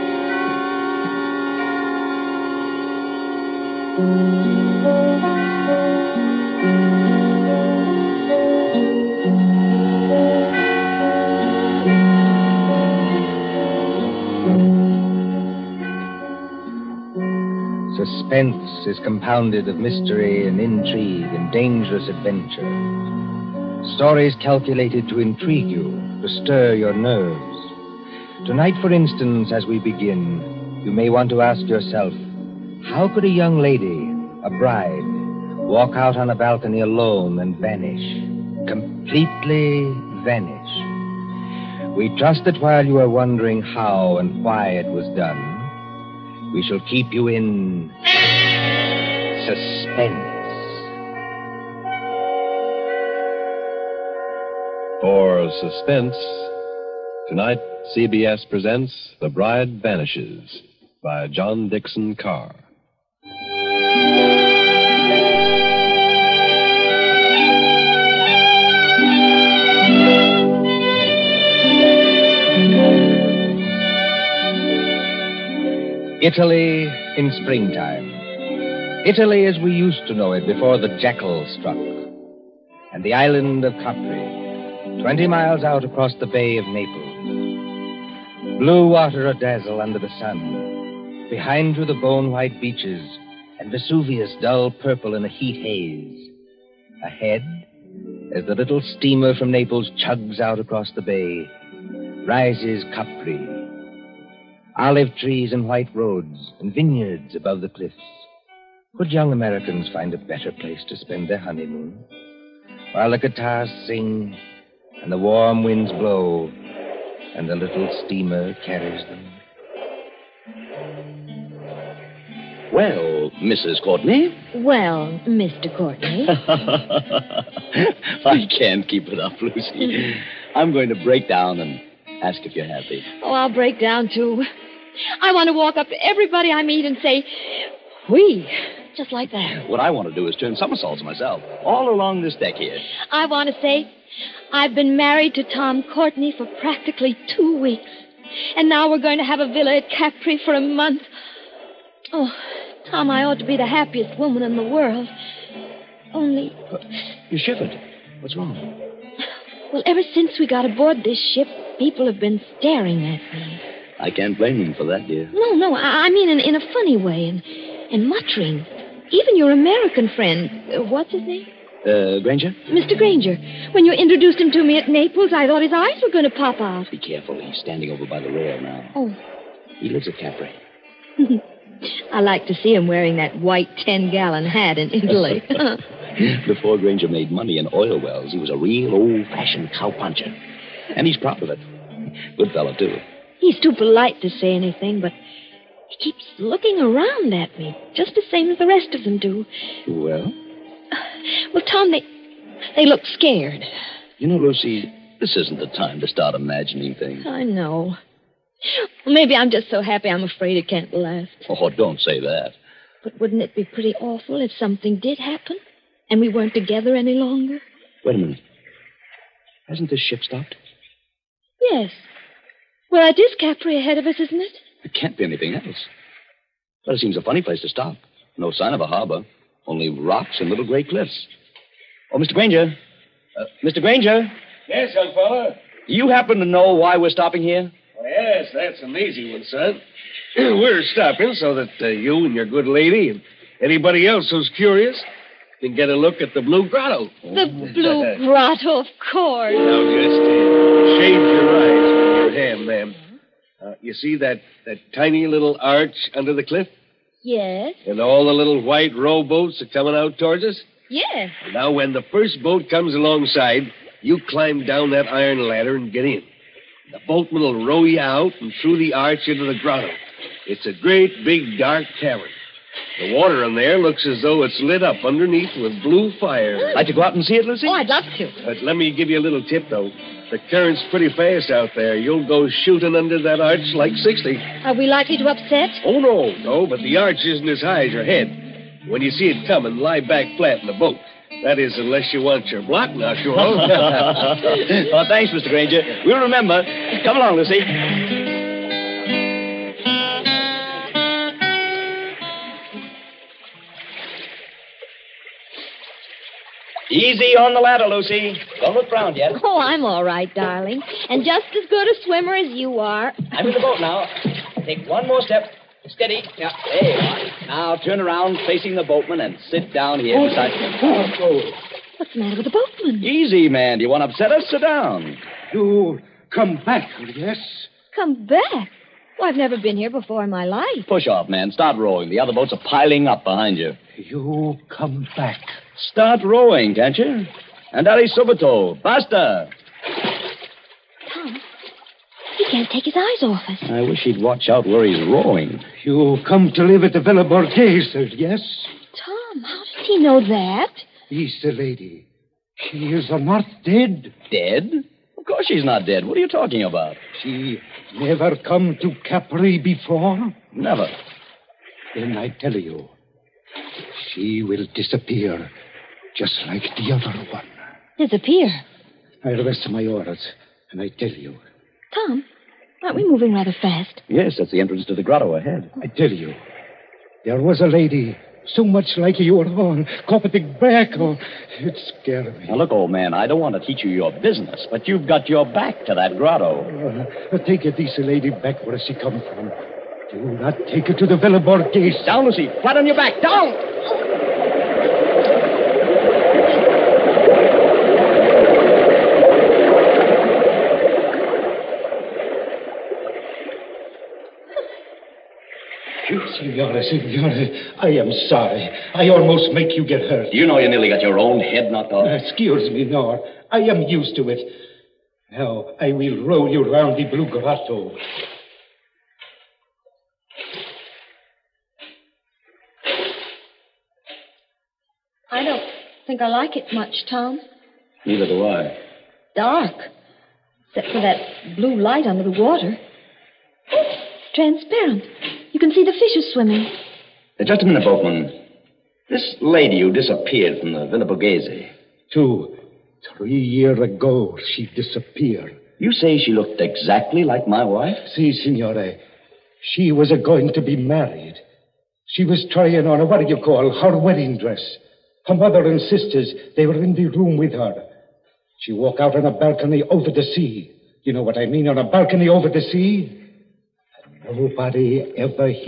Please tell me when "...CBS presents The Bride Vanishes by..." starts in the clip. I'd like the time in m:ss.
0:57.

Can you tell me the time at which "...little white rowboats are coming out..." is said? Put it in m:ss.
4:18.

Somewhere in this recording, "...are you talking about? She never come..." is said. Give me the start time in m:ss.
5:56.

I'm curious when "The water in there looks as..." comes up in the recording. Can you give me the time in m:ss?
4:32.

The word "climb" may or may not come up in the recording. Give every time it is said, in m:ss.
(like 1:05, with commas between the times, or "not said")
4:24.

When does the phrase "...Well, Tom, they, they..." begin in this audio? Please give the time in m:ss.
3:21.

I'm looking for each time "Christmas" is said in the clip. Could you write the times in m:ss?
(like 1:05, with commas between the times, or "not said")
not said.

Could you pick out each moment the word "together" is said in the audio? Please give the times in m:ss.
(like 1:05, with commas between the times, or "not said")
3:36.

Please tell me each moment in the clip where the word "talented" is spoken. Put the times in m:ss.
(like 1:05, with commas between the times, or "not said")
not said.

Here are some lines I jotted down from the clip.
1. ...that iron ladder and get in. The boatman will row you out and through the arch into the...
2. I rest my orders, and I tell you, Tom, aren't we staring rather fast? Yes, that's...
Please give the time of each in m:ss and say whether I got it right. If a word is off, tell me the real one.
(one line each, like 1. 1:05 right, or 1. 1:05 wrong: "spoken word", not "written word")
1. 4:24 right
2. 6:09 wrong: "moving", not "staring".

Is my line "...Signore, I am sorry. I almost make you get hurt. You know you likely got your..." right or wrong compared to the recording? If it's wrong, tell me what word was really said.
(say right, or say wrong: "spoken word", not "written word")
wrong: "nearly", not "likely".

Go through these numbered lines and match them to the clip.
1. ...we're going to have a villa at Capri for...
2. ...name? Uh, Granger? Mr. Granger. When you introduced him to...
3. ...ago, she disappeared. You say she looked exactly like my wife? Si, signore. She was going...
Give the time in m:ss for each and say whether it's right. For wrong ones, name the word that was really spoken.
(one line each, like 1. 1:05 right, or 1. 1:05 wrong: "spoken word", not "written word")
1. 2:28 right
2. 2:51 right
3. 7:23 right.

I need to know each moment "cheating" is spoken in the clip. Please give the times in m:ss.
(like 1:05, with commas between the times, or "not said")
not said.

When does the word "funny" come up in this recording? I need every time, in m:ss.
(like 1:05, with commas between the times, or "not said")
2:46, 3:47.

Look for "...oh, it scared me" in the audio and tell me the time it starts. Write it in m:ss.
6:20.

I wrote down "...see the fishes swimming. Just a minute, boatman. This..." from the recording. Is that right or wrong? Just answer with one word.
right.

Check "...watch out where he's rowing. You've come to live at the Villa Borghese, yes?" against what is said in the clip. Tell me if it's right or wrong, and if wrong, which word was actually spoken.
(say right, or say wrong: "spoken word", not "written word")
right.